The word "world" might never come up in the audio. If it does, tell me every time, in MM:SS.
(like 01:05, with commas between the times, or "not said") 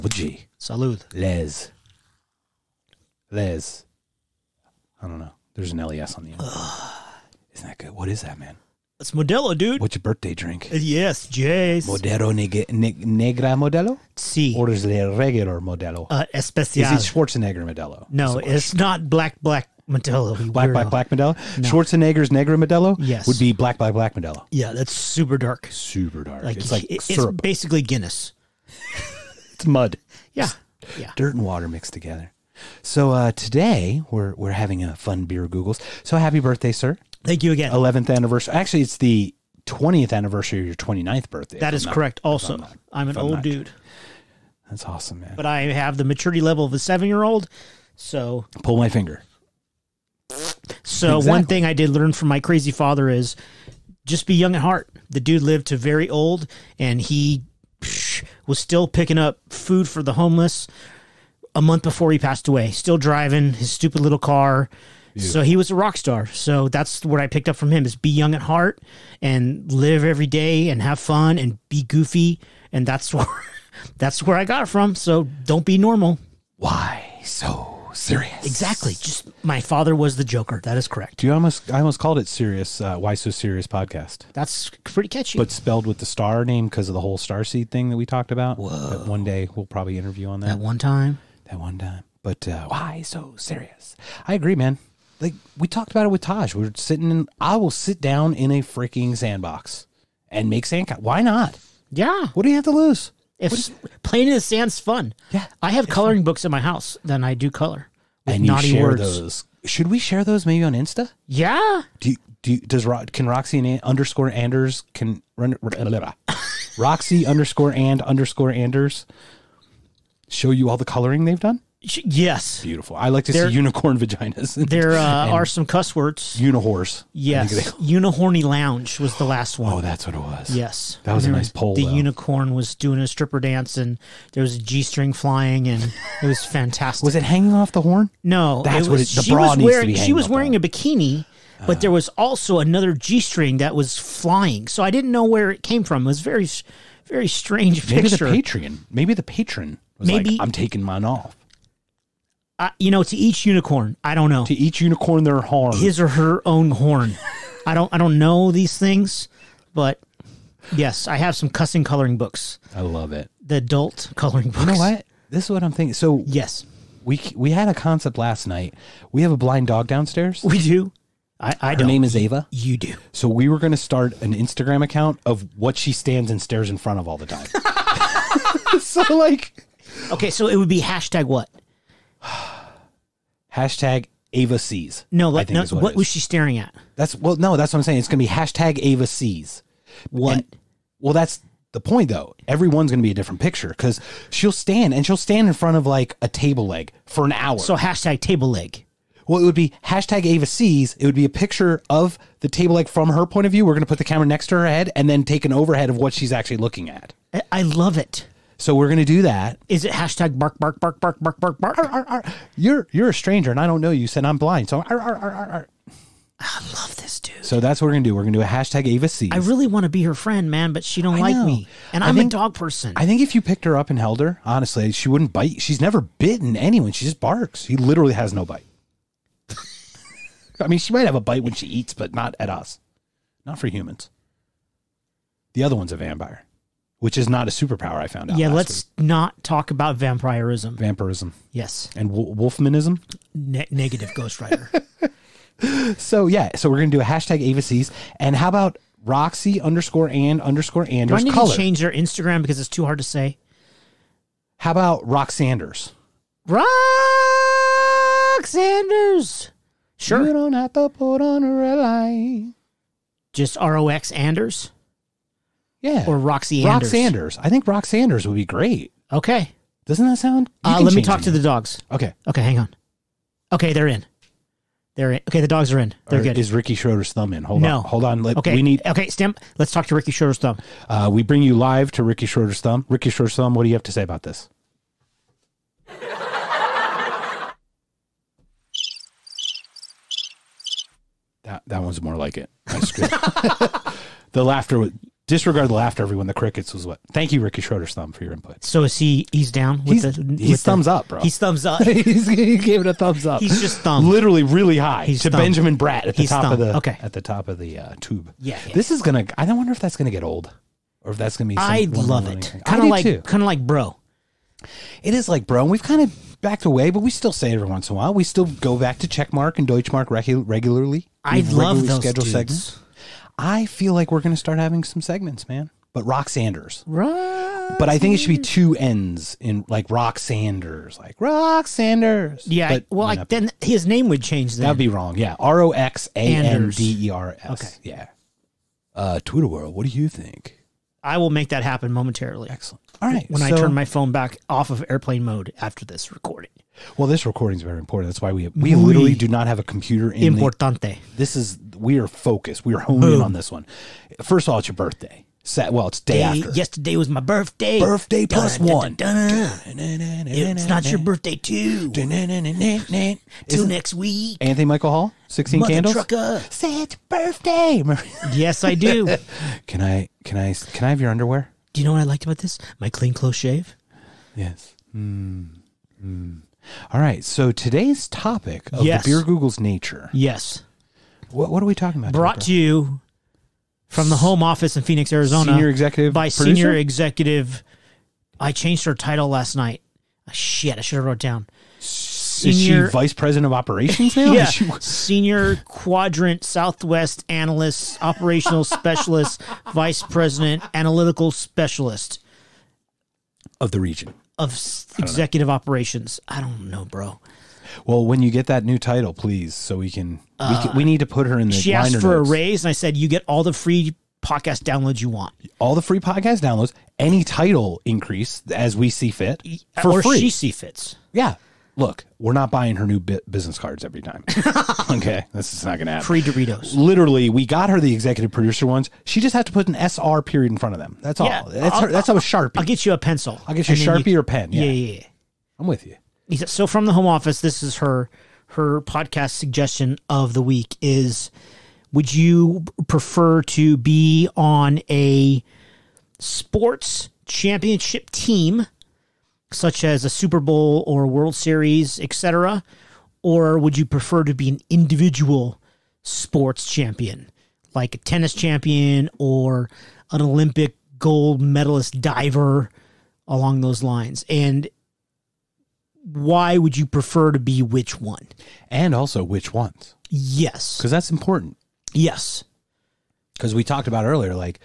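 05:39, 07:31.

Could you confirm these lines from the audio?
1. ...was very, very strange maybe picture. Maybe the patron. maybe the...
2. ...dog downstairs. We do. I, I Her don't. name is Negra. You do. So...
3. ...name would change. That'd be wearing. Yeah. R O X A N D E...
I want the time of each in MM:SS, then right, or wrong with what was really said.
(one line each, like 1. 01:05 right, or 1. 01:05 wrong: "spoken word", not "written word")
1. 02:26 right
2. 02:49 wrong: "Ava", not "Negra"
3. 05:33 wrong: "wrong", not "wearing".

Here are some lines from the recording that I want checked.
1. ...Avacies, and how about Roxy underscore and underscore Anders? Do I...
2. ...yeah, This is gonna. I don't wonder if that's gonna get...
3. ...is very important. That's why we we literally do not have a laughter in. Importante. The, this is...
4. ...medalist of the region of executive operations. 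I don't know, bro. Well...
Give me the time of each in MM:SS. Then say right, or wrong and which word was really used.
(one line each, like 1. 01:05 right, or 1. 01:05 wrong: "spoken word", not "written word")
1. 04:07 right
2. 05:08 right
3. 05:47 wrong: "computer", not "laughter"
4. 06:41 wrong: "specialist", not "medalist".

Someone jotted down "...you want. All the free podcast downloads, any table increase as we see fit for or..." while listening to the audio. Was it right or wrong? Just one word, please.
wrong.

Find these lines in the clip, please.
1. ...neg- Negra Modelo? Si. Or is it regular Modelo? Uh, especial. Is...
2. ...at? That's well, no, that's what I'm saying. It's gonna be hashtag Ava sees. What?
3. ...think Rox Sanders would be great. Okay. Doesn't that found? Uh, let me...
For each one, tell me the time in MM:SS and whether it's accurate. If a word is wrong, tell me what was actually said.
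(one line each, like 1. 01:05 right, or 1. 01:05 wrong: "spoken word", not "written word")
1. 00:12 right
2. 03:06 right
3. 04:27 wrong: "sound", not "found".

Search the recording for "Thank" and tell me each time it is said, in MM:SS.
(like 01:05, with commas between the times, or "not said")
00:37, 04:57.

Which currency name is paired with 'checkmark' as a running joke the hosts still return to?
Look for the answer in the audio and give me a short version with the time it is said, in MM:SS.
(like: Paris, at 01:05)
Deutschmark, at 05:19.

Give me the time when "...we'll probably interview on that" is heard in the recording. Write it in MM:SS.
01:29.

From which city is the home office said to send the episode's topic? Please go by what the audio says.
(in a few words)
Phoenix, Arizona.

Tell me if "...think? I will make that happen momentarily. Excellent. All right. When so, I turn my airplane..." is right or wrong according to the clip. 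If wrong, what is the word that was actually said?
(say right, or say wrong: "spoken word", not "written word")
wrong: "phone", not "airplane".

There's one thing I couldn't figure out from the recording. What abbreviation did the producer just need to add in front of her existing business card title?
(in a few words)
SR.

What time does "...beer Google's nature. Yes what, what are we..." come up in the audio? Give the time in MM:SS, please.
06:19.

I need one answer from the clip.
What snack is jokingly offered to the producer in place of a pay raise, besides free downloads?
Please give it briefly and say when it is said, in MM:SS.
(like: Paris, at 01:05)
Doritos, at 07:06.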